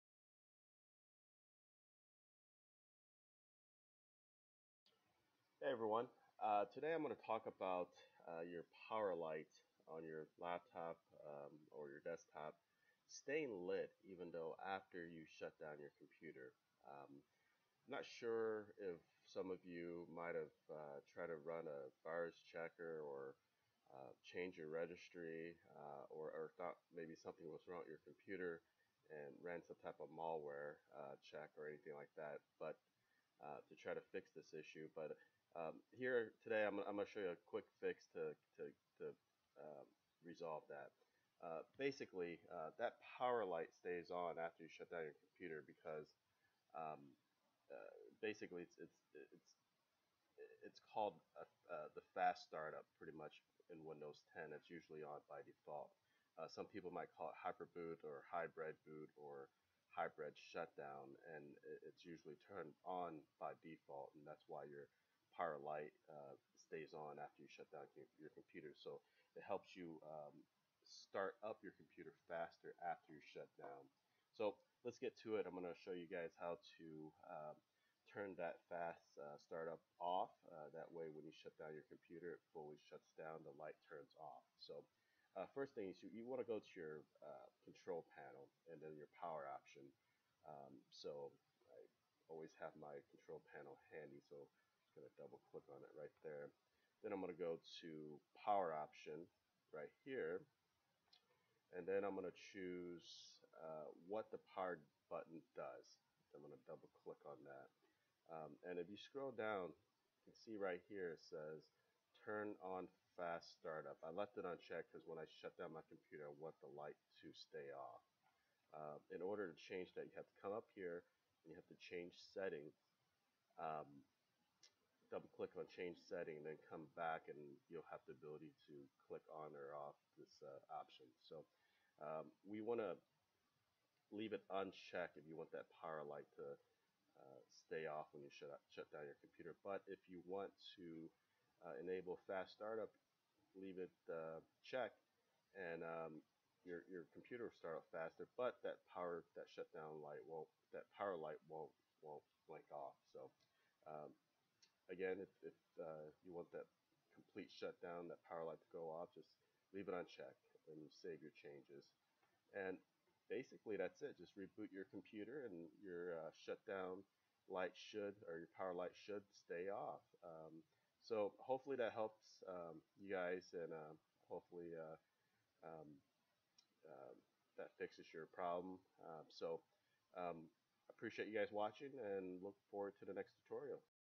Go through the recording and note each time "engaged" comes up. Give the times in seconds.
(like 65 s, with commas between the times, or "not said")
not said.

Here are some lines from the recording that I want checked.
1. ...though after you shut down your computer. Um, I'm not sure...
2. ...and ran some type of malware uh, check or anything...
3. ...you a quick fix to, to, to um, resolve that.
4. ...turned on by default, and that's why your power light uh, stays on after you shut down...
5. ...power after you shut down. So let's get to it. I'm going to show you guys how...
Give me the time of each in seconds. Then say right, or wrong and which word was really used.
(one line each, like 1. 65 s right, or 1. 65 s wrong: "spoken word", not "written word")
1. 14 s right
2. 29 s right
3. 37 s right
4. 62 s right
5. 72 s wrong: "faster", not "power".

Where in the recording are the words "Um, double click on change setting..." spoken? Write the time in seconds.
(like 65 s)
123 s.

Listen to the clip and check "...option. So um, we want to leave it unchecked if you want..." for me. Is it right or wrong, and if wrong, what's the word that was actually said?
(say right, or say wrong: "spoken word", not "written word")
right.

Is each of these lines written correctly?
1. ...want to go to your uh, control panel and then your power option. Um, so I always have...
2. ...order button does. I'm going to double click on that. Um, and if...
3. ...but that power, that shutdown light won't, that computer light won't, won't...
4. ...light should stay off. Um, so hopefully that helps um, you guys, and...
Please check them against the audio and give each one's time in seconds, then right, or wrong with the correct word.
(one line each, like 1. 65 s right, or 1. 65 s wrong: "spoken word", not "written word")
1. 86 s right
2. 104 s wrong: "power", not "order"
3. 148 s wrong: "power", not "computer"
4. 168 s right.